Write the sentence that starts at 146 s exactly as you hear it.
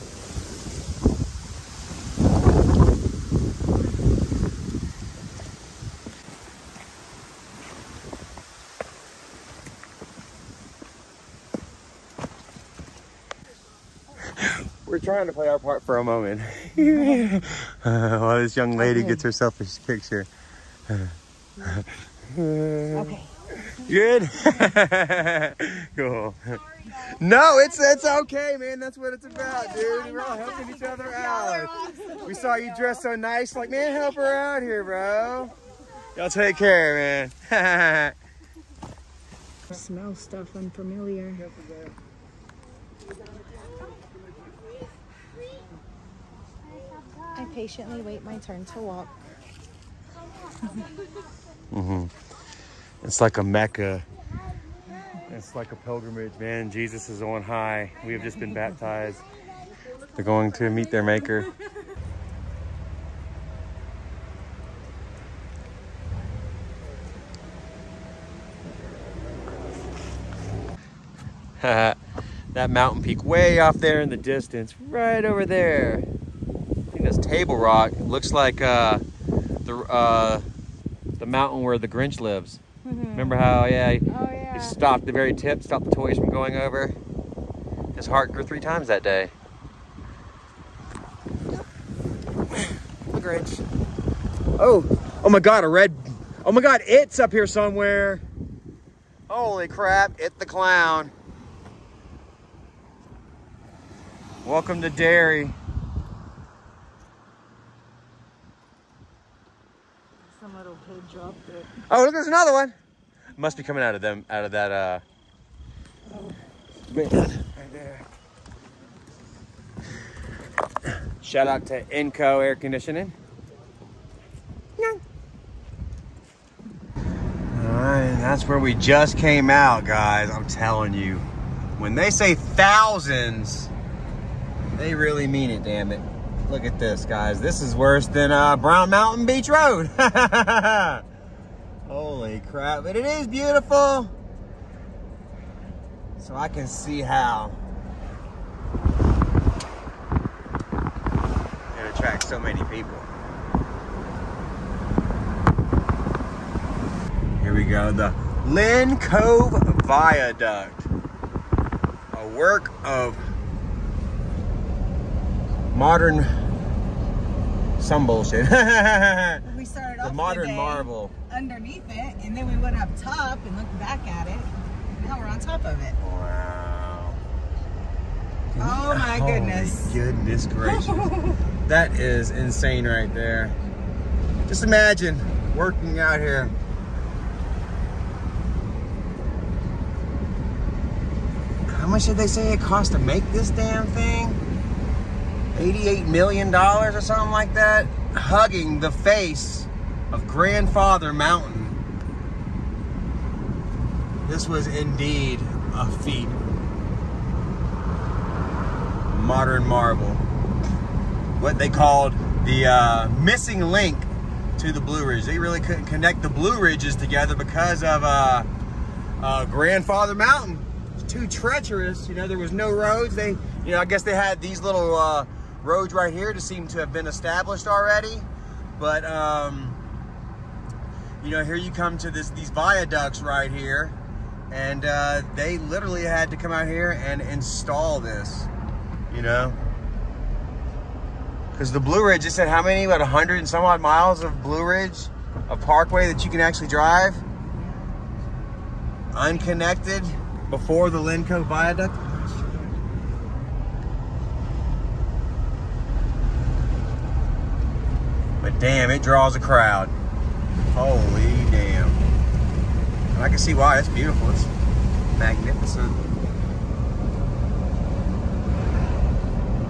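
So I can see how it attracts so many people.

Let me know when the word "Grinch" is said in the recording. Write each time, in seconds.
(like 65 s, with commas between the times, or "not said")
81 s, 93 s.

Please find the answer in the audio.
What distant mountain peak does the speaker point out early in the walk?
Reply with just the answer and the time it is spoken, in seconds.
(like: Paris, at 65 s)
Table Rock, at 77 s.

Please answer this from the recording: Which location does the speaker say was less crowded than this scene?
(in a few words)
Brown Mountain Beach Road.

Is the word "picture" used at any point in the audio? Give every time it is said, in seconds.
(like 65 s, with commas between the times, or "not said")
19 s.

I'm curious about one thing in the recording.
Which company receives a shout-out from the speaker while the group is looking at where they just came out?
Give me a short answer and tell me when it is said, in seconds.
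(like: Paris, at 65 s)
Inco Air Conditioning, at 121 s.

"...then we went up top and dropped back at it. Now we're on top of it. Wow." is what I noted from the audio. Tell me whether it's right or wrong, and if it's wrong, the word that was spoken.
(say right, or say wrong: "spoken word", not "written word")
wrong: "looked", not "dropped".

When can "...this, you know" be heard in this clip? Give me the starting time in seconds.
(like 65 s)
237 s.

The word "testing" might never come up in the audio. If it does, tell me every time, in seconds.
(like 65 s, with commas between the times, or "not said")
not said.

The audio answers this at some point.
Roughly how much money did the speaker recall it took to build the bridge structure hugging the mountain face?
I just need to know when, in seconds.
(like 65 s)
195 s.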